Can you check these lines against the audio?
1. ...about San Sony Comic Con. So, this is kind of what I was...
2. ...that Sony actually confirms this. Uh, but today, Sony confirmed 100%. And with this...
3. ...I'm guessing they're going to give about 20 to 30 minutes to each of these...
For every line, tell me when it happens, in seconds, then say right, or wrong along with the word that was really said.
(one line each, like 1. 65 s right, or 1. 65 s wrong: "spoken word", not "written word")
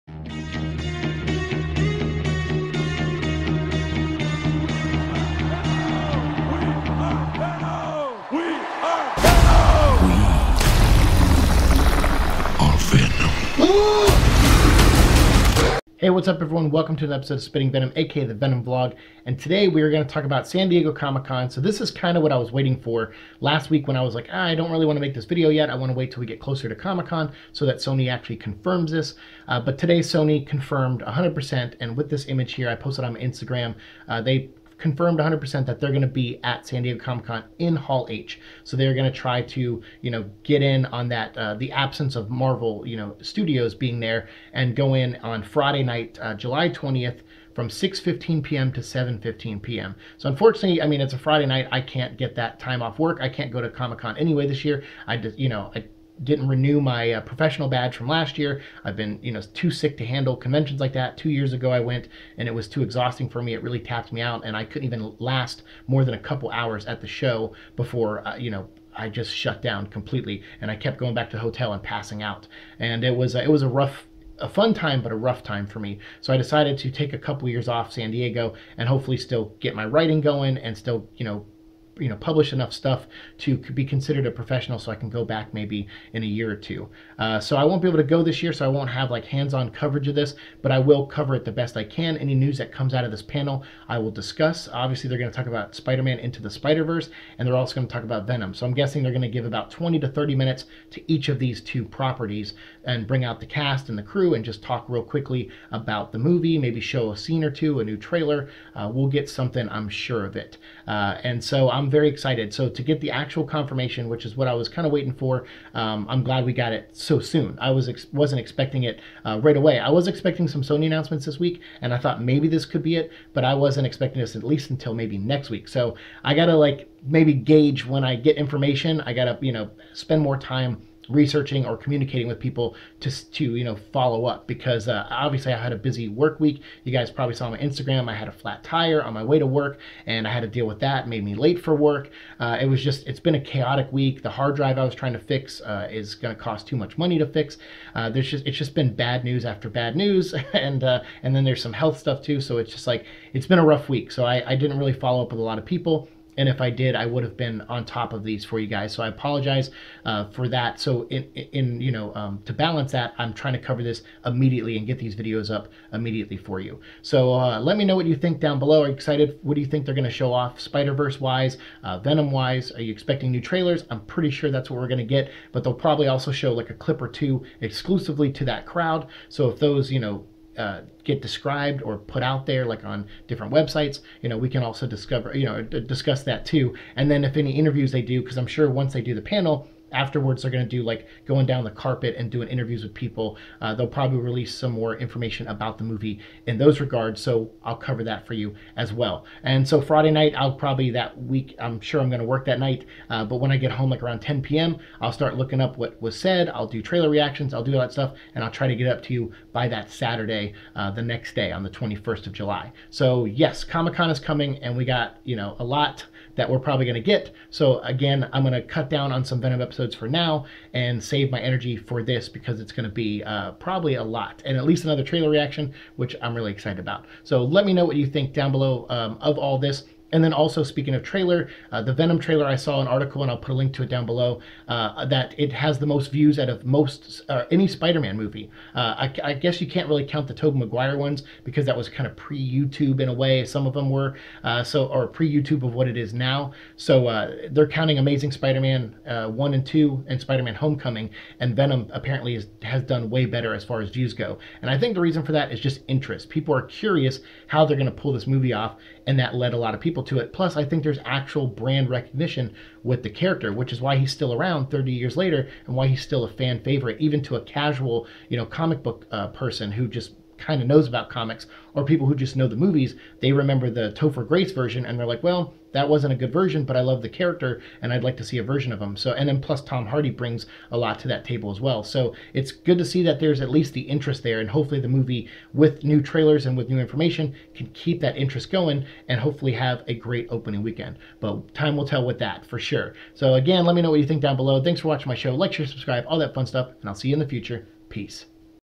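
1. 20 s wrong: "Diego", not "Sony"
2. 27 s right
3. 98 s right.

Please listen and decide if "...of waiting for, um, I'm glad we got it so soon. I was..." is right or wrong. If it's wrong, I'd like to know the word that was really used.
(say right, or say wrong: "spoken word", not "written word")
right.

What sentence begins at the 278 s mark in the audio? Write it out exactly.
So, and then plus Tom Hardy brings a lot to that table as well.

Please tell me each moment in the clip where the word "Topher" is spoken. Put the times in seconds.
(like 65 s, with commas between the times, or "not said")
273 s.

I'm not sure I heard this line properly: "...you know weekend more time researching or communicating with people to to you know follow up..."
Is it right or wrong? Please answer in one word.
wrong.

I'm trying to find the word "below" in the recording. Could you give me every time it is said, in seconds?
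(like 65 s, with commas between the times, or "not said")
168 s, 228 s, 234 s, 294 s.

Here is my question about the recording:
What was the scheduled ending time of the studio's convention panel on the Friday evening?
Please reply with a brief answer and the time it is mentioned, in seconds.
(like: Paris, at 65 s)
7:15 p.m., at 48 s.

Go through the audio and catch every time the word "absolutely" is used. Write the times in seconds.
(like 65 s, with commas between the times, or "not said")
not said.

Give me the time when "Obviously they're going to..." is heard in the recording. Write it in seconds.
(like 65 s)
94 s.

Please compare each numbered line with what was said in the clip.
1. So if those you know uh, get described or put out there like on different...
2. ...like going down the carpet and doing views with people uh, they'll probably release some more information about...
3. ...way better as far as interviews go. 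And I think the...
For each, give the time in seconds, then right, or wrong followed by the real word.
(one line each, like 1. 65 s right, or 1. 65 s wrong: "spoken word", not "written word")
1. 179 s right
2. 190 s wrong: "interviews", not "views"
3. 253 s wrong: "views", not "interviews".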